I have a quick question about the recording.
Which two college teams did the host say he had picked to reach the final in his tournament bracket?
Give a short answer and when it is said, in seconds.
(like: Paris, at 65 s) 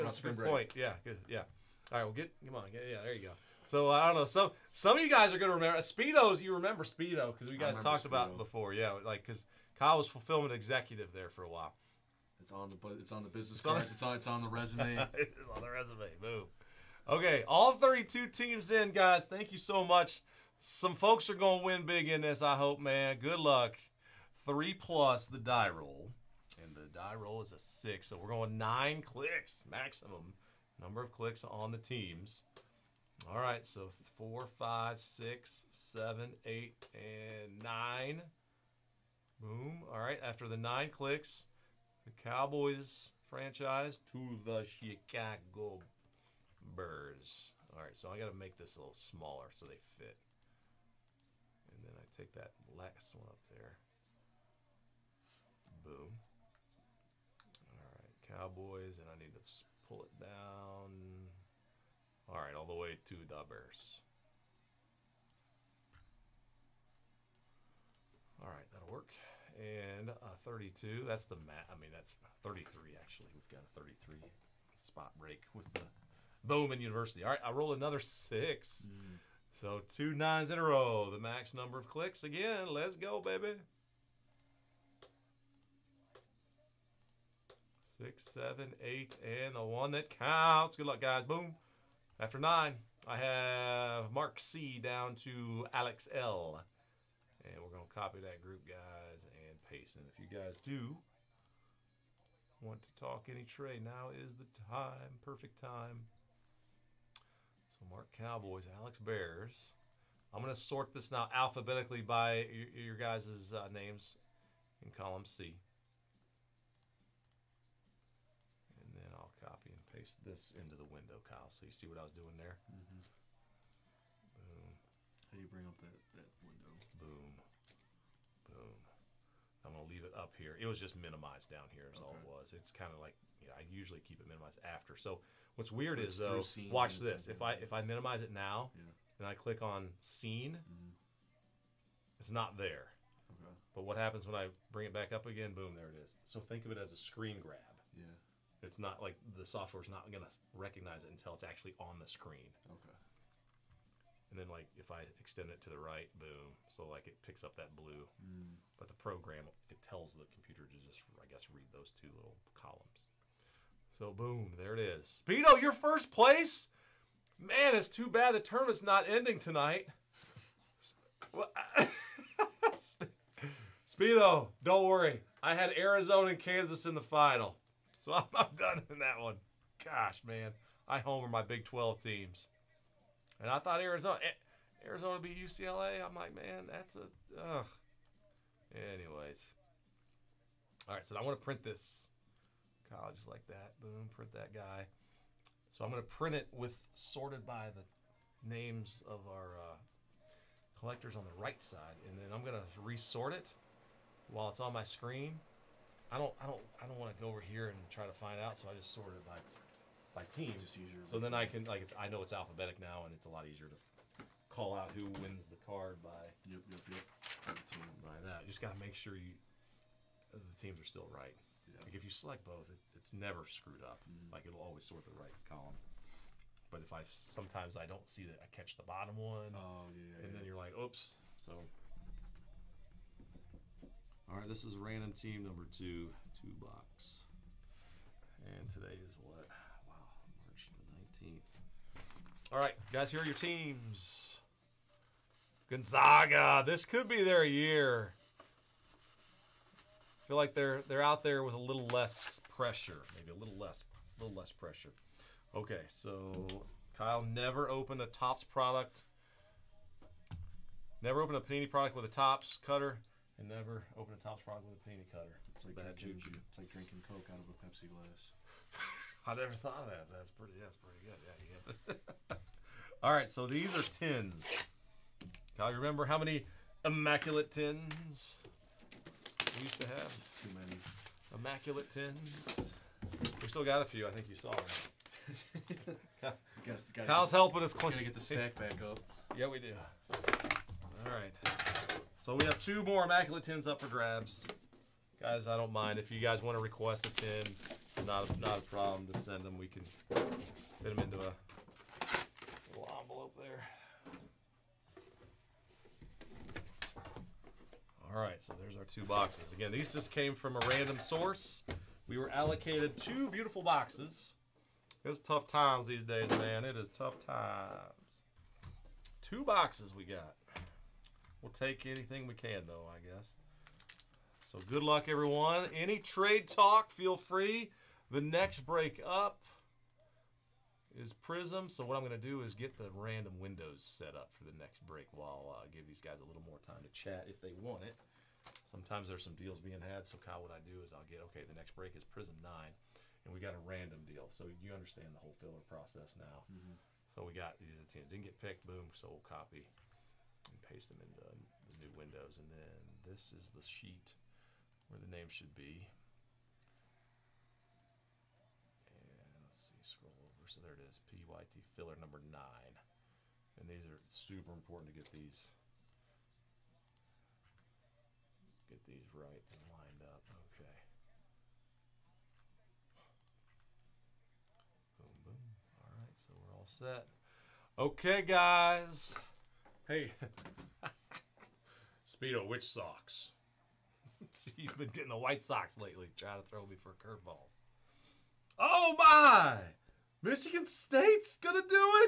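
Arizona and Kansas, at 175 s.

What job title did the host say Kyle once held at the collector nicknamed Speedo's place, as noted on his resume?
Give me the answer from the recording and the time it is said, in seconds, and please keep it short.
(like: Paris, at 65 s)
Fulfillment executive, at 10 s.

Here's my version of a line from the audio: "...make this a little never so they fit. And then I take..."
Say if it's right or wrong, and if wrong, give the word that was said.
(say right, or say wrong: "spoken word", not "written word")
wrong: "smaller", not "never".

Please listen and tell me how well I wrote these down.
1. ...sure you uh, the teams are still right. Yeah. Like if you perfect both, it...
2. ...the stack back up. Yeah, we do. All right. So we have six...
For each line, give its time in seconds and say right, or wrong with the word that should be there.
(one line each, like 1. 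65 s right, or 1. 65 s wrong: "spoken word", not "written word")
1. 218 s wrong: "select", not "perfect"
2. 288 s wrong: "two", not "six".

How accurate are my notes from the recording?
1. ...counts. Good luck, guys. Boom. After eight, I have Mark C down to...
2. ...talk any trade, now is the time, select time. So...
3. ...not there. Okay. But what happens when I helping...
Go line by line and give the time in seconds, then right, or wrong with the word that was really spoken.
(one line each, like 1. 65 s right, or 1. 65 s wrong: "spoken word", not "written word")
1. 90 s wrong: "nine", not "eight"
2. 103 s wrong: "perfect", not "select"
3. 142 s wrong: "bring", not "helping".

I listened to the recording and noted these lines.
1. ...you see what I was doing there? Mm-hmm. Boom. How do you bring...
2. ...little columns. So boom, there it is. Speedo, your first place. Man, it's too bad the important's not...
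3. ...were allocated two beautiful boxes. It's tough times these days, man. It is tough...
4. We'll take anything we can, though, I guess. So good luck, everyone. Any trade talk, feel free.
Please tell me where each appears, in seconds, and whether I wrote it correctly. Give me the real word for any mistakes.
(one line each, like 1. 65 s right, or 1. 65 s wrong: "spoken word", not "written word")
1. 121 s right
2. 162 s wrong: "tournament", not "important"
3. 312 s right
4. 321 s right.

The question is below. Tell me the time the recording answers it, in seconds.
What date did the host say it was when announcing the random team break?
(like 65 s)
240 s.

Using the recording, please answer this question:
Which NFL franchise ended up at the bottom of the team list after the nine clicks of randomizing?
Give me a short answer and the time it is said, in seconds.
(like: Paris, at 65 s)
Chicago Bears, at 44 s.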